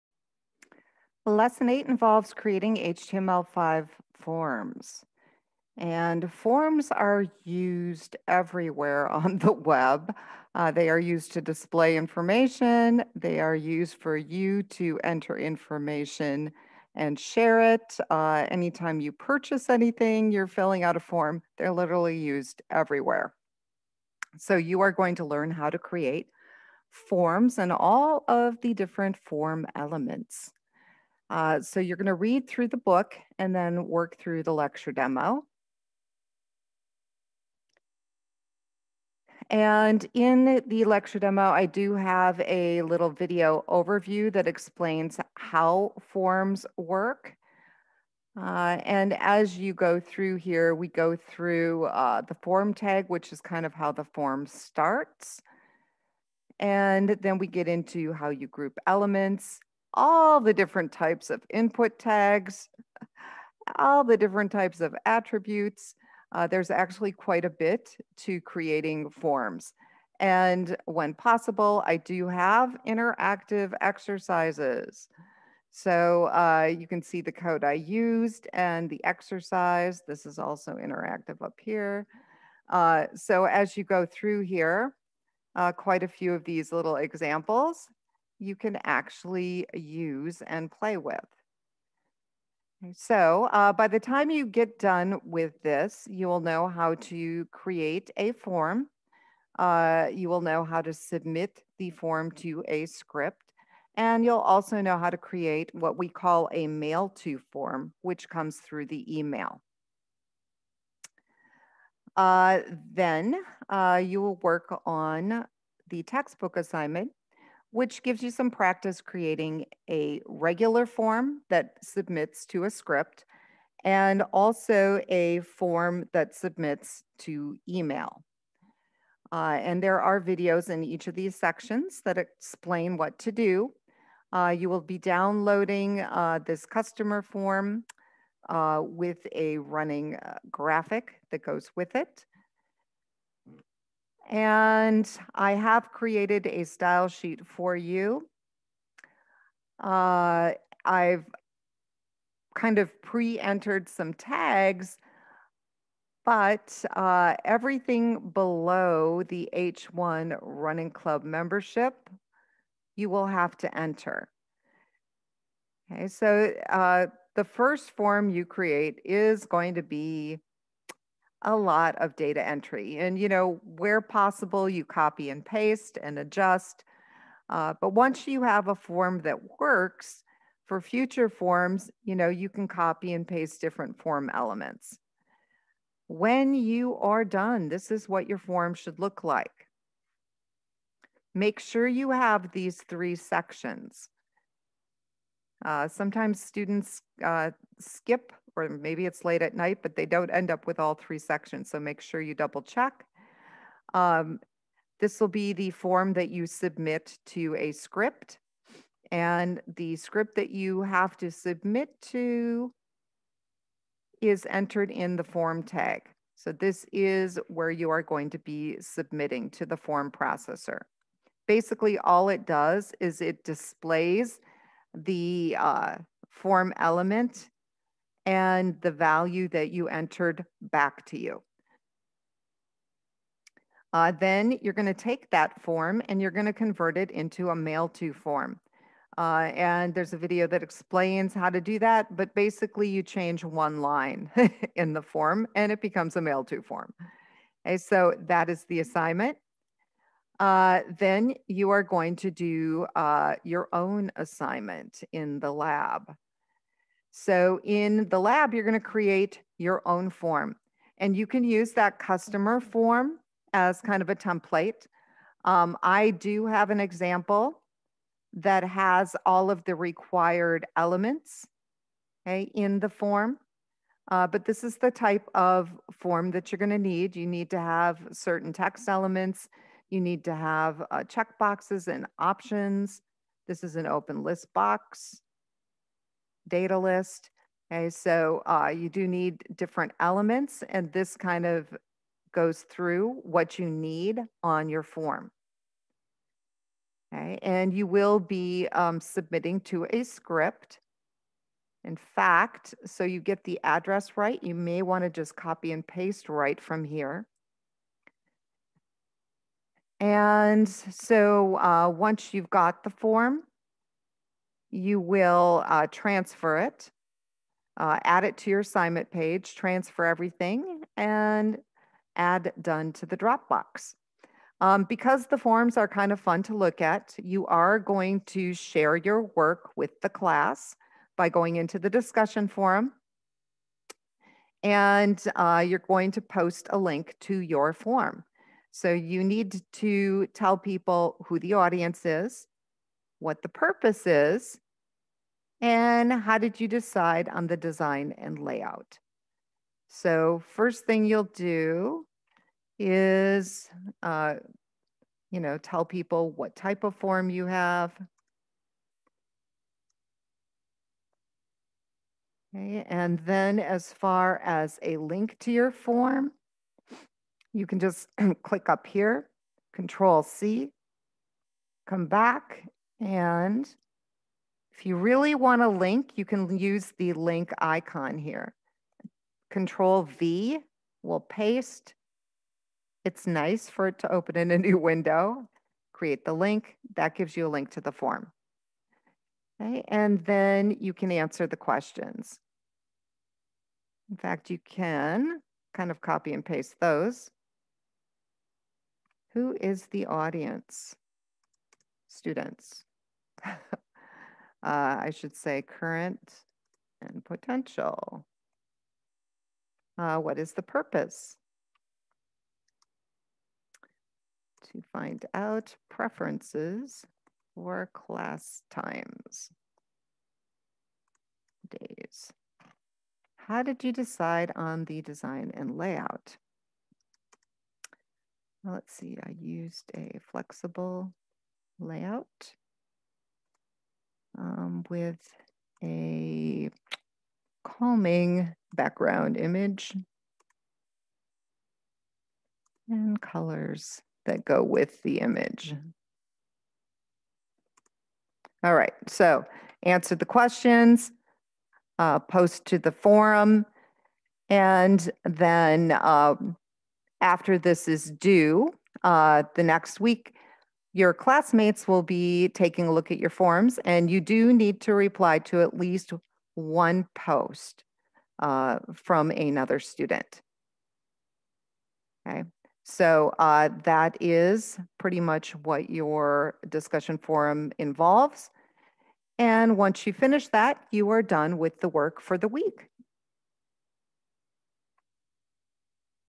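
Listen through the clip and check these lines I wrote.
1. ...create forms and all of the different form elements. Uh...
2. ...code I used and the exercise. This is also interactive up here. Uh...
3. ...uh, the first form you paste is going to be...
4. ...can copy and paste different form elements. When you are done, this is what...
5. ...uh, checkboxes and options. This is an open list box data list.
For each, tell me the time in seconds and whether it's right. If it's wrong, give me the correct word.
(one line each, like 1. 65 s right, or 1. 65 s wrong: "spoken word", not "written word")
1. 25 s right
2. 77 s right
3. 166 s wrong: "create", not "paste"
4. 182 s right
5. 280 s right.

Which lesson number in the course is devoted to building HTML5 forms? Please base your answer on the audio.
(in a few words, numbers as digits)
8.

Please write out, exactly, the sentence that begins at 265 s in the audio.
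Um, I do have an example that has all of the required elements okay, in the form.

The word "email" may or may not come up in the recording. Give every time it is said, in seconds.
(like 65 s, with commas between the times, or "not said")
109 s, 127 s.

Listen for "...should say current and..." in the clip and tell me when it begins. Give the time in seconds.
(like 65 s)
405 s.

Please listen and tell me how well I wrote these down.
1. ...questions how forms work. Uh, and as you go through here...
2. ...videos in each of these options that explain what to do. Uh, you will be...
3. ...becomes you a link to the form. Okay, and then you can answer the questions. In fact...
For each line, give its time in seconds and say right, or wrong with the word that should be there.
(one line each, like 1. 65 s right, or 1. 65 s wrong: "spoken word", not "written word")
1. 44 s wrong: "explains", not "questions"
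2. 130 s wrong: "sections", not "options"
3. 387 s wrong: "gives", not "becomes".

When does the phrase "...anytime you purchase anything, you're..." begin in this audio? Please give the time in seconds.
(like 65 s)
18 s.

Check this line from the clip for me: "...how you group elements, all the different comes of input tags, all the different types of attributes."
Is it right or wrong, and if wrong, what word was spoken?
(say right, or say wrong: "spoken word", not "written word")
wrong: "types", not "comes".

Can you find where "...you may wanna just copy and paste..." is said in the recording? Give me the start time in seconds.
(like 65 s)
304 s.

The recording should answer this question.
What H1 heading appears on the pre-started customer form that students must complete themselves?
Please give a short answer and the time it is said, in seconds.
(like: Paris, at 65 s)
running club membership, at 160 s.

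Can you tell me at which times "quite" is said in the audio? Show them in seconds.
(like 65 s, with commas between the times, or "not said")
67 s, 85 s.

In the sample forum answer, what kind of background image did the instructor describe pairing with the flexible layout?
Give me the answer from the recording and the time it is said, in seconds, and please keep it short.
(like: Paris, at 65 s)
calming, at 437 s.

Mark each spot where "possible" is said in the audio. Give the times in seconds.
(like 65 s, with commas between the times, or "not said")
71 s, 174 s.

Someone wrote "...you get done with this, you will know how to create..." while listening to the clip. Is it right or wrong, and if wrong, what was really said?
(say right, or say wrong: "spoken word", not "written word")
right.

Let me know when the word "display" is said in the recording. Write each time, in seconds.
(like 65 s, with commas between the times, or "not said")
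11 s, 223 s.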